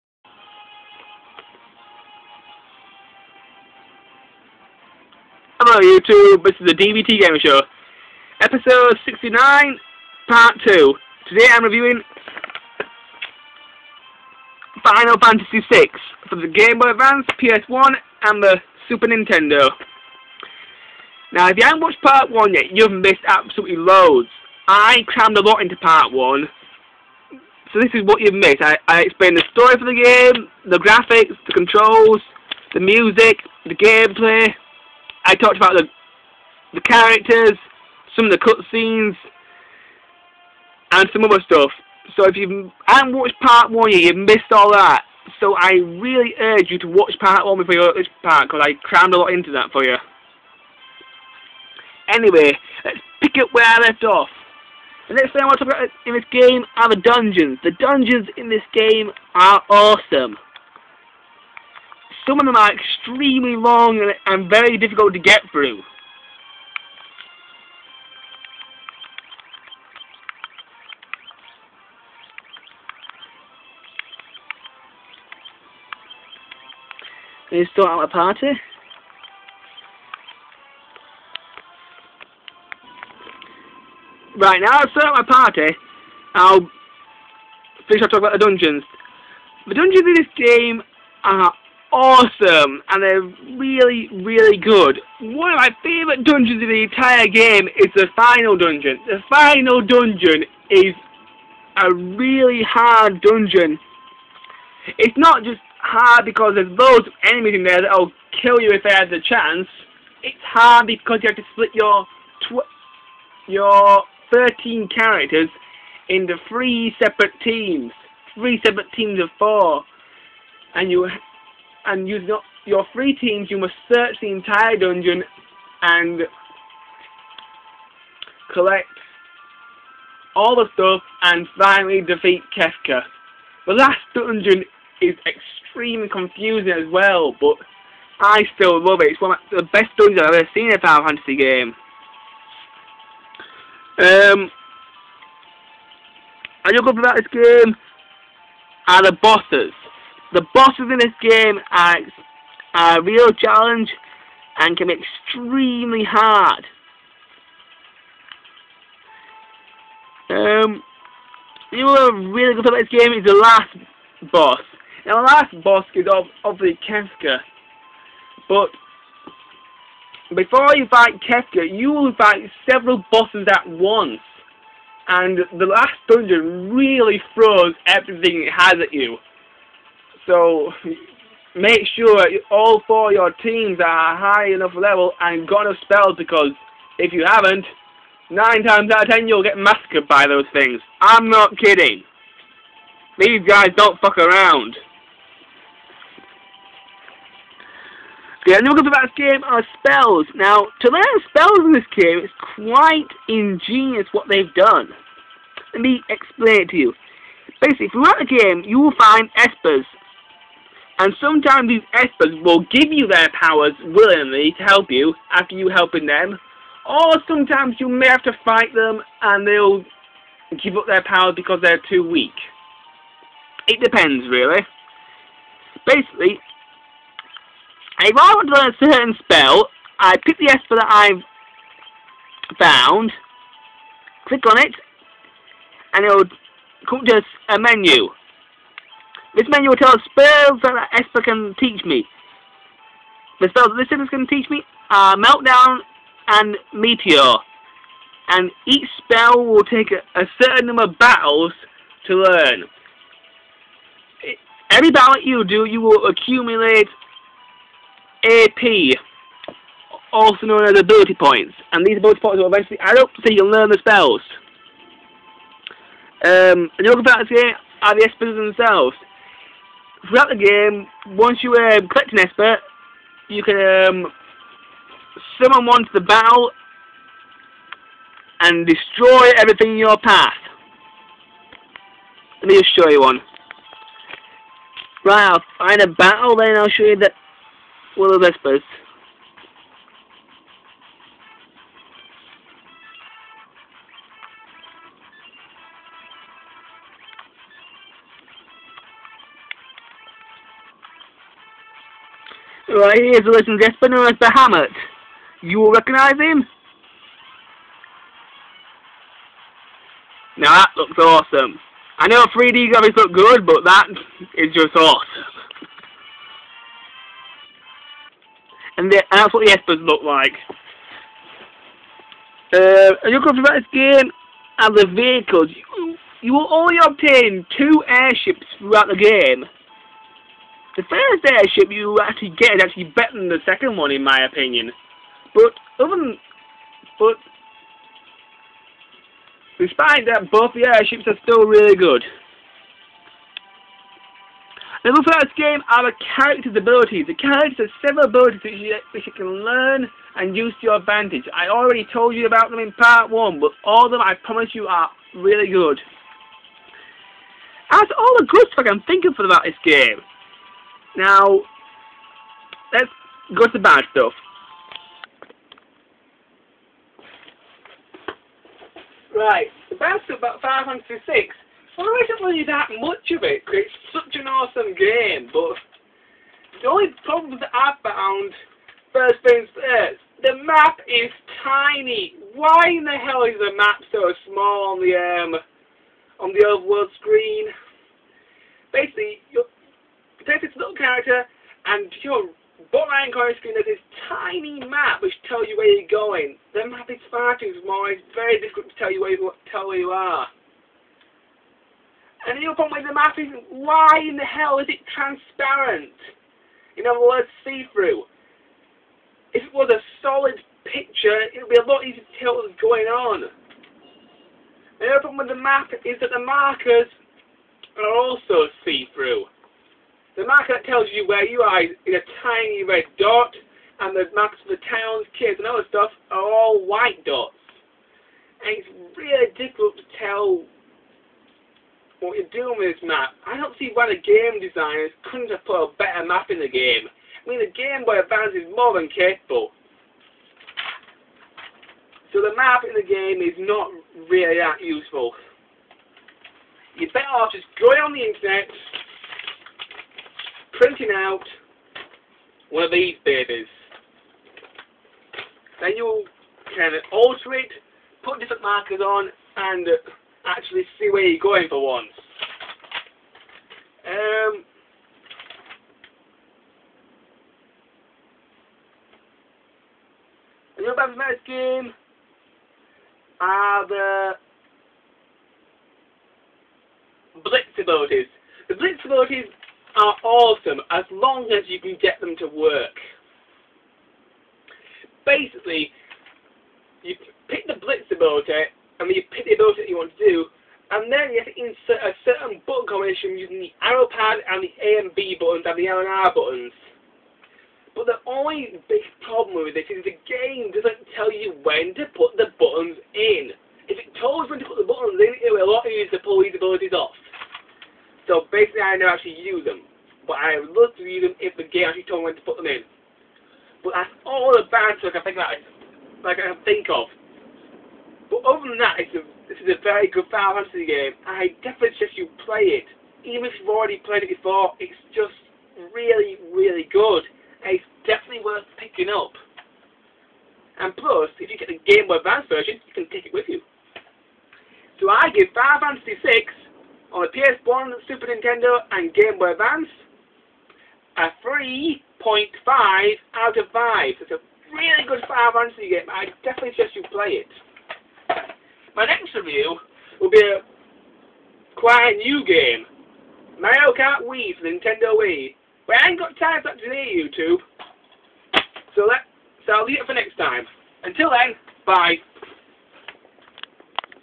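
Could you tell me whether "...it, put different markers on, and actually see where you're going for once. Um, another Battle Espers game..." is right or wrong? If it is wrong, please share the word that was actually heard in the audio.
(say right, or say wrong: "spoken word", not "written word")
wrong: "Knights", not "Espers".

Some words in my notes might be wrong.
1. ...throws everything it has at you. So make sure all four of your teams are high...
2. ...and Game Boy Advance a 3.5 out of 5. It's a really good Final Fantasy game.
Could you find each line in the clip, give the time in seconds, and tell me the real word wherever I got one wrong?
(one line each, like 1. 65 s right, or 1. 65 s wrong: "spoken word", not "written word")
1. 177 s right
2. 538 s right.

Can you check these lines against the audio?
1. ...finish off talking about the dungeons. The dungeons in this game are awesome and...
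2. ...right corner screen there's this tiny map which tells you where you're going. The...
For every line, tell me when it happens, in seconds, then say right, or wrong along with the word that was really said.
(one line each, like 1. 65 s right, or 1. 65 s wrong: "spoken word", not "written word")
1. 87 s right
2. 392 s right.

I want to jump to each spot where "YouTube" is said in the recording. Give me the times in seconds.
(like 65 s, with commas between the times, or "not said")
5 s, 556 s.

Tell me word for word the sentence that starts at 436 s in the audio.
I mean, the Game Boy Advance is more than capable.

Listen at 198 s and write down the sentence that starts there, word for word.
The only good about this game are spells.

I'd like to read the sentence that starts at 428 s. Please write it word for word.
And it's really difficult to tell what you're doing with this map.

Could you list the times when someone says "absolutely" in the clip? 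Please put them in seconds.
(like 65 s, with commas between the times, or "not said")
23 s.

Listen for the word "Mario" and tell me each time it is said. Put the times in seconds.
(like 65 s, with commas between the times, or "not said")
553 s.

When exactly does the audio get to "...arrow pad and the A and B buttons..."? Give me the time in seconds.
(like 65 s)
493 s.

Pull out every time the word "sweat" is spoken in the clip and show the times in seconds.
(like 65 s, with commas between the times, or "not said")
not said.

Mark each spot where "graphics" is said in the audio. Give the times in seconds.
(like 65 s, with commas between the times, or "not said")
30 s, 312 s.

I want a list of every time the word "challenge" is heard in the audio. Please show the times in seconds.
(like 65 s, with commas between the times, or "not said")
153 s.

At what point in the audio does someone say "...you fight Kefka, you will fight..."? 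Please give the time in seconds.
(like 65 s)
170 s.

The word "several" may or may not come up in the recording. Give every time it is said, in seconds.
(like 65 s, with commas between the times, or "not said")
172 s, 347 s.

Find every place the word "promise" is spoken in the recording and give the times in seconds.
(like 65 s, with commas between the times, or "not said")
354 s.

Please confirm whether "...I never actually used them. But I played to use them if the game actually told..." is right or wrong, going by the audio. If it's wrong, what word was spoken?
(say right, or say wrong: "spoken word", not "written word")
wrong: "looked", not "played".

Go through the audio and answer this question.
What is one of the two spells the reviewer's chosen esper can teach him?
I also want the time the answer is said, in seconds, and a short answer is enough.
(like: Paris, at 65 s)
Meteor, at 246 s.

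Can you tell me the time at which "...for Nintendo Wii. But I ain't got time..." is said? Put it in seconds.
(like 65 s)
554 s.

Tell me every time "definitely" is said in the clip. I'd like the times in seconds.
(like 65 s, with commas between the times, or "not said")
521 s, 527 s, 546 s.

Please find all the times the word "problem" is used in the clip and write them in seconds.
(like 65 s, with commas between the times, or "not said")
377 s, 402 s, 415 s, 499 s.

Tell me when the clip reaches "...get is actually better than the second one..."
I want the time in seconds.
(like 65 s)
332 s.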